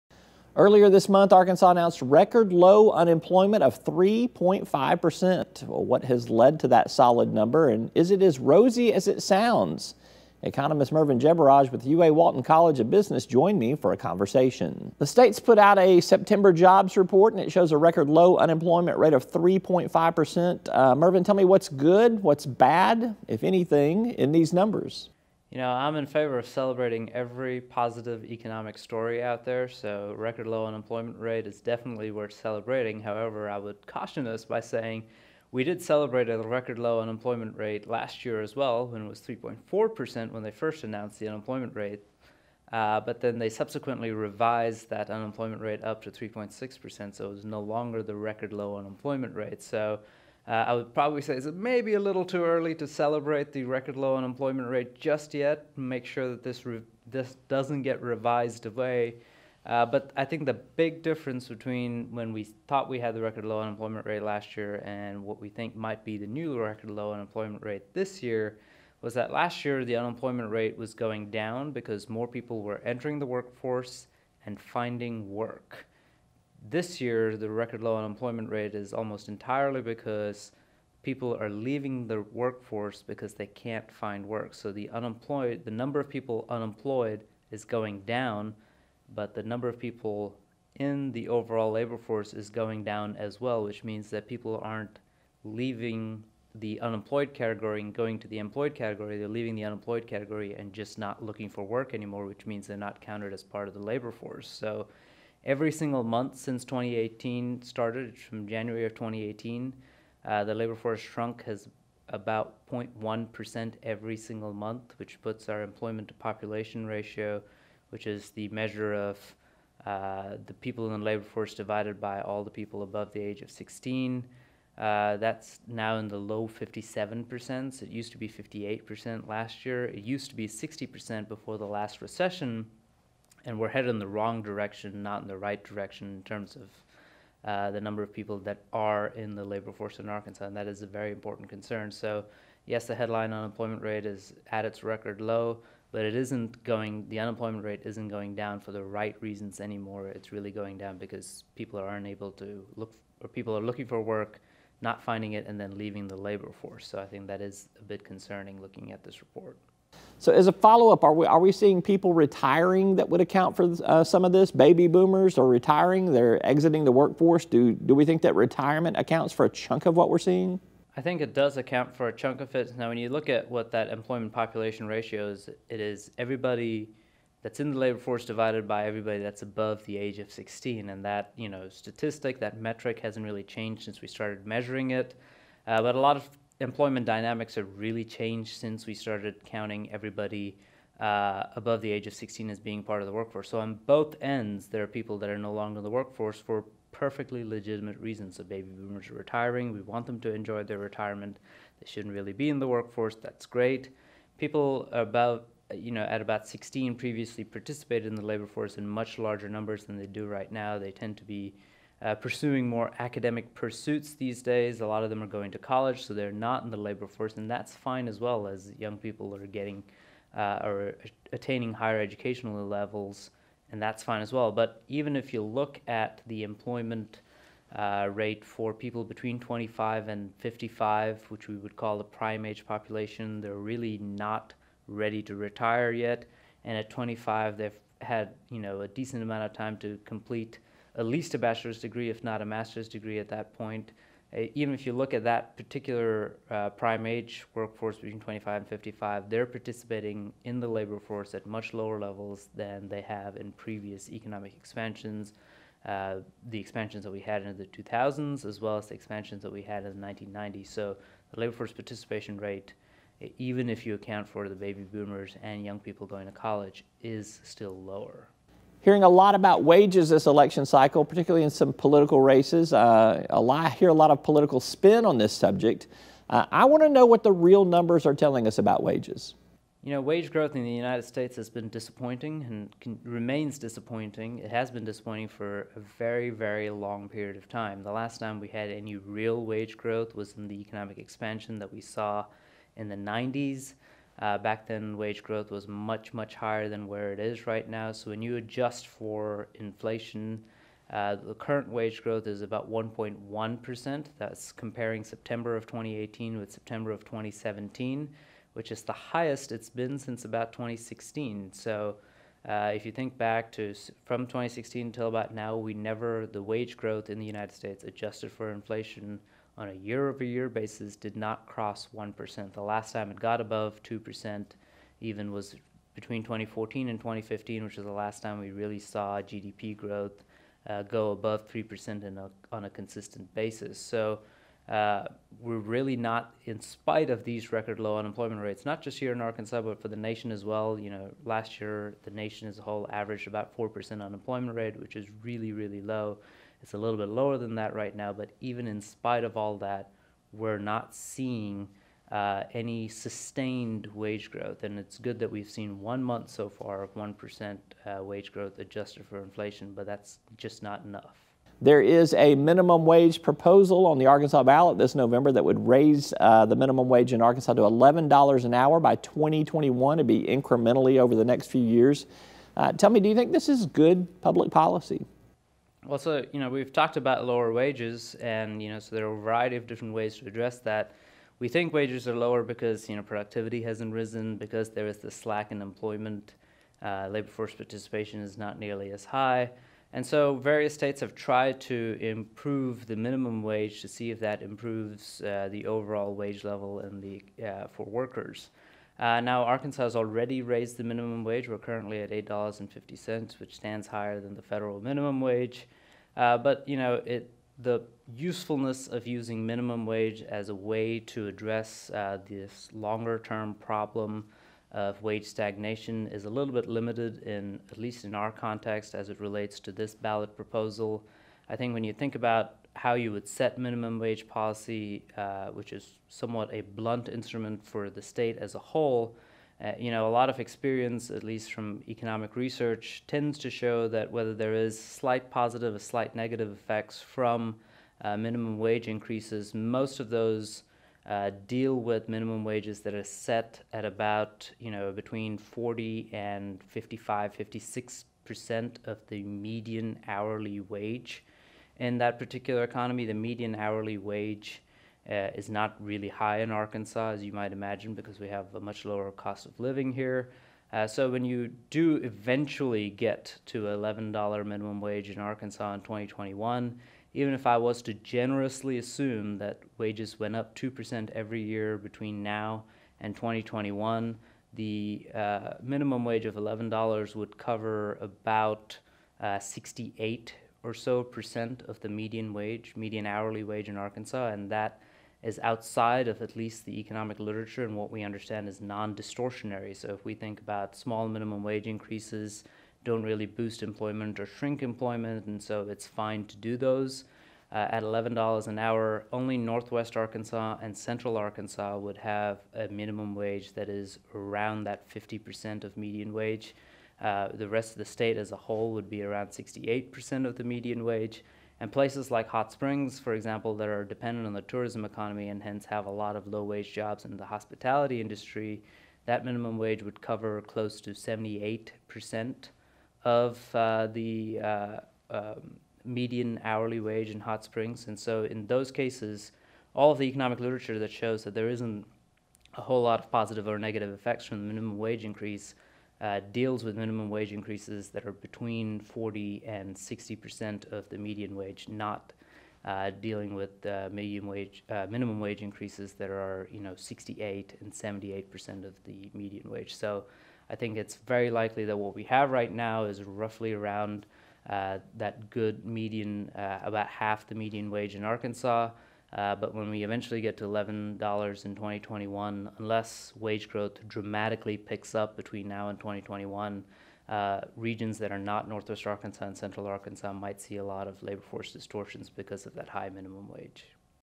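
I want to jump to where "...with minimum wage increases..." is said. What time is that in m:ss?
8:56.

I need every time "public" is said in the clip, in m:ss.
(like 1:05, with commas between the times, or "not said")
6:14.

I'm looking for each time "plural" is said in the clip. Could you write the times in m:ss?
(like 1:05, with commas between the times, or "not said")
not said.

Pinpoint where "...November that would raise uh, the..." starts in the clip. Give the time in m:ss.
6:04.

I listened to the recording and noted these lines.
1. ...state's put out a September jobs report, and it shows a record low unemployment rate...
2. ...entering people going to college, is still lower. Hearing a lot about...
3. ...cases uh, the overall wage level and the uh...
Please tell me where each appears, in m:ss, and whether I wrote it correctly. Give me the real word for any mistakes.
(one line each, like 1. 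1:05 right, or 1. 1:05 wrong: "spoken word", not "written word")
1. 0:15 right
2. 4:25 wrong: "young", not "entering"
3. 6:34 wrong: "improves", not "cases".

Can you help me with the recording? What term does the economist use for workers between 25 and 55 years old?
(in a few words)
prime age population.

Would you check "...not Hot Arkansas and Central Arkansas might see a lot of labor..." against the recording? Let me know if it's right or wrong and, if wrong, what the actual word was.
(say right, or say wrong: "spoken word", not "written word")
wrong: "Northwest", not "Hot".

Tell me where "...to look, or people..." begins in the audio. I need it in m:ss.
2:32.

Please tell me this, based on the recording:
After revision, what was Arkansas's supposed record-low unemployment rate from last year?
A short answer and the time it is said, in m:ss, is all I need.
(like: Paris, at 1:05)
3.6%, at 0:46.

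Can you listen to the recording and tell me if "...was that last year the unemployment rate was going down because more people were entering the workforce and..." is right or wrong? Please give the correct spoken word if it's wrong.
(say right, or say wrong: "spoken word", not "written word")
right.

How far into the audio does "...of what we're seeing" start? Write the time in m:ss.
2:49.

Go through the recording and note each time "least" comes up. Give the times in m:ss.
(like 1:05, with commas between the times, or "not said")
4:01, 6:57, 7:11, 8:06.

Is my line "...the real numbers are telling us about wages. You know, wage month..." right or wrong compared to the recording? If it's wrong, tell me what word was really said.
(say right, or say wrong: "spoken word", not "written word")
wrong: "growth", not "month".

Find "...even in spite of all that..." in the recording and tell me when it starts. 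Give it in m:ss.
5:48.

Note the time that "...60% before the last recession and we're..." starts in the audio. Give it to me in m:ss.
2:10.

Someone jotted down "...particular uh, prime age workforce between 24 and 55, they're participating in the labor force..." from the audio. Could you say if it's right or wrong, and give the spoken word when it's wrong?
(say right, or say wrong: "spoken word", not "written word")
wrong: "25", not "24".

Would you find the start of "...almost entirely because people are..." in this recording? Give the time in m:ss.
1:18.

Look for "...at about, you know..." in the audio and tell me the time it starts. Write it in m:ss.
7:23.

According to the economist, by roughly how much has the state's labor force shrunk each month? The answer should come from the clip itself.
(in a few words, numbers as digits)
0.1%.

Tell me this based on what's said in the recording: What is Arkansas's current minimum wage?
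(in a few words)
$8.50.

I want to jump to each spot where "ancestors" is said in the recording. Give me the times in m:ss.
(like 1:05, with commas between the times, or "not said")
not said.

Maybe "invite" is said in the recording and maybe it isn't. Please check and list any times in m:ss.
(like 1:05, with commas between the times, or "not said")
not said.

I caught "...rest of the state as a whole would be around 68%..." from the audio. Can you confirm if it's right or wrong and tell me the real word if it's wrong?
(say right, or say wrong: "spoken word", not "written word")
right.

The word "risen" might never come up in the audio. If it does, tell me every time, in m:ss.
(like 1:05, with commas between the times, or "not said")
6:23.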